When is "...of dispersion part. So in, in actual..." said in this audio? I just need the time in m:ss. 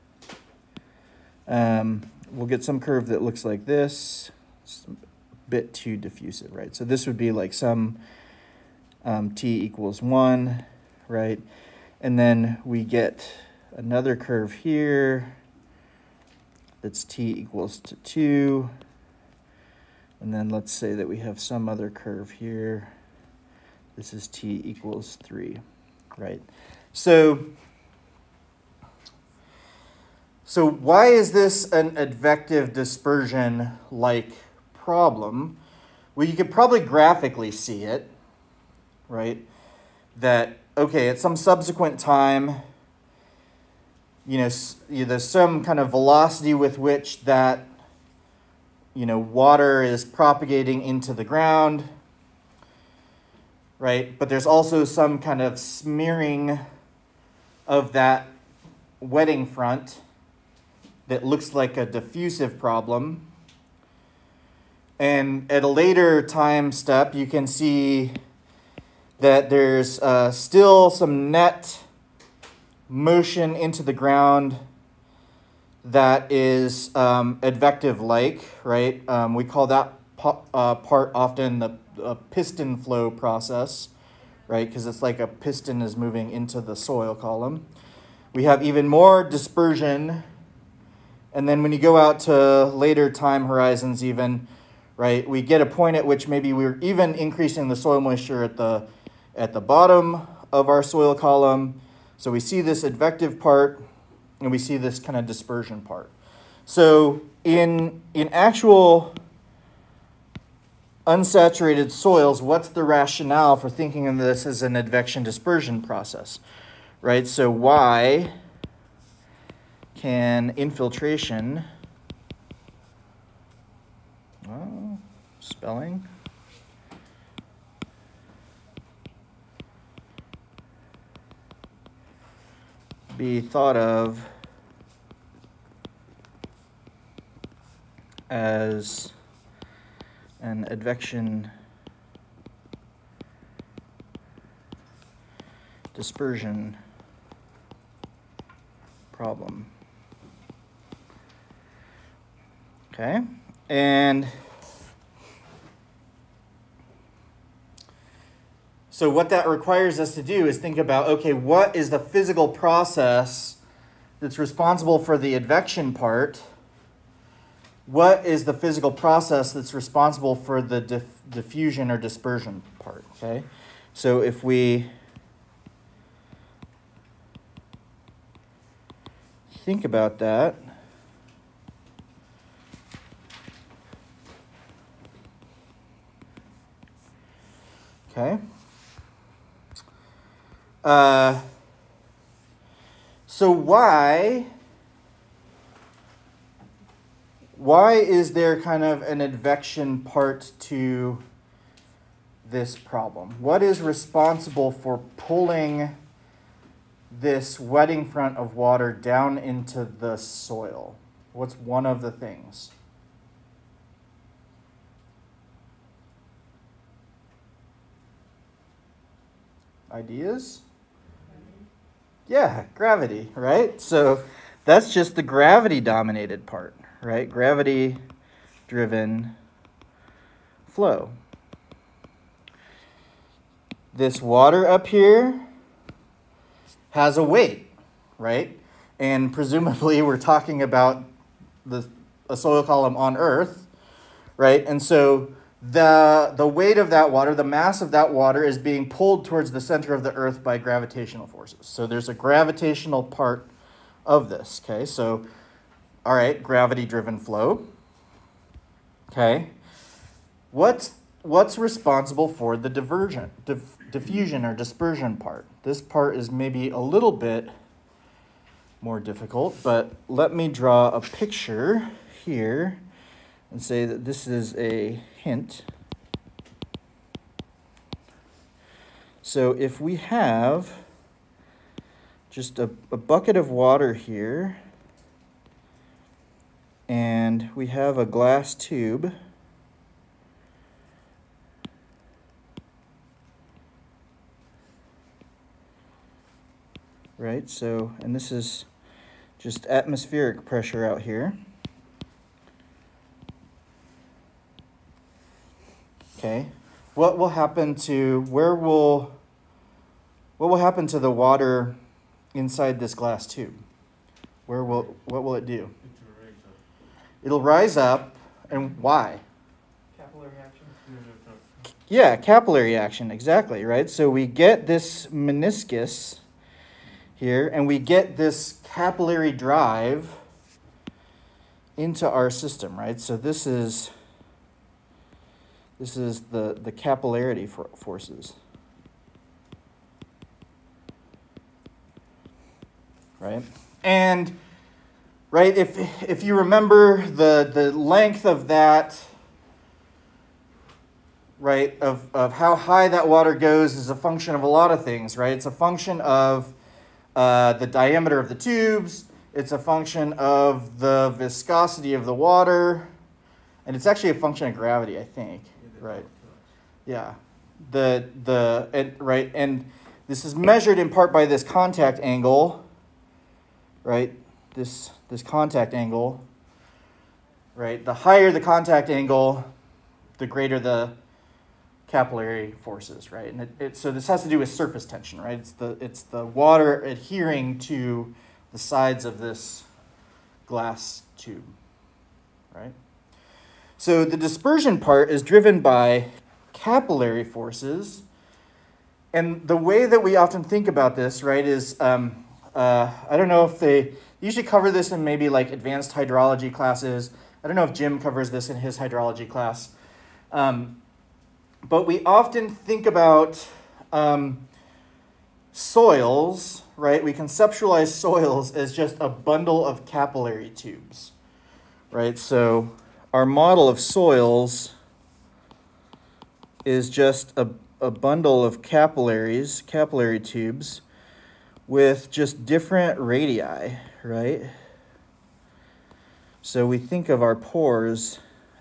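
1:45.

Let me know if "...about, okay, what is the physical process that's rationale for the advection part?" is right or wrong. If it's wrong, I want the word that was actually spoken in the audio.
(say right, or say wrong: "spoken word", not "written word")
wrong: "responsible", not "rationale".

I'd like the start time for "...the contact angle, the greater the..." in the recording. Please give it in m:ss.
6:18.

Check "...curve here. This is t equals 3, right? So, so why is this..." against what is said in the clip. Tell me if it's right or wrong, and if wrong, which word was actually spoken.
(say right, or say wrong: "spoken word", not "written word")
right.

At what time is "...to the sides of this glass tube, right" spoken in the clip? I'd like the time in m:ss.
6:27.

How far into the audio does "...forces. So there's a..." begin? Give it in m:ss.
4:11.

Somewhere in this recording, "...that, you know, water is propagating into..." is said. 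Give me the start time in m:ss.
0:47.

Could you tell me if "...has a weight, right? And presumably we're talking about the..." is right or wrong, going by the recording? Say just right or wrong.
right.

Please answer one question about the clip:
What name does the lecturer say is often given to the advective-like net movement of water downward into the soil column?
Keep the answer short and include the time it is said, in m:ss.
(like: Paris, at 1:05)
piston flow, at 1:22.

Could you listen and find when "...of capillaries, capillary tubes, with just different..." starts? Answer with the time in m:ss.
7:08.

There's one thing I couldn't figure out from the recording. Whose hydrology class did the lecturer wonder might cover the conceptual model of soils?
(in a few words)
Jim.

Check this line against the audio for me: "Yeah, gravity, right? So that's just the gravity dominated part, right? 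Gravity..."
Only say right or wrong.
right.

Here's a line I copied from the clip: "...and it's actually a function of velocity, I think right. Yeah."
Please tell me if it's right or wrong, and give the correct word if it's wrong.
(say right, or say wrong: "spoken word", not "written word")
wrong: "gravity", not "velocity".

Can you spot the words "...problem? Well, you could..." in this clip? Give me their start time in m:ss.
0:34.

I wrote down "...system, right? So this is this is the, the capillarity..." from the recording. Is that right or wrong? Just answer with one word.
right.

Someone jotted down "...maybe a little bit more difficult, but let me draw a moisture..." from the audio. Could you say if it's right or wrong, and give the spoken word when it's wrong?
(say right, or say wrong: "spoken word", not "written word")
wrong: "picture", not "moisture".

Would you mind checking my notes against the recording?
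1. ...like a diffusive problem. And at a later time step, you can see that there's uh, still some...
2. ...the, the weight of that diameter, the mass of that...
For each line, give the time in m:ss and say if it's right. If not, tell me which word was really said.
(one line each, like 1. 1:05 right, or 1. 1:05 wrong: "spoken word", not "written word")
1. 1:01 right
2. 4:05 wrong: "water", not "diameter".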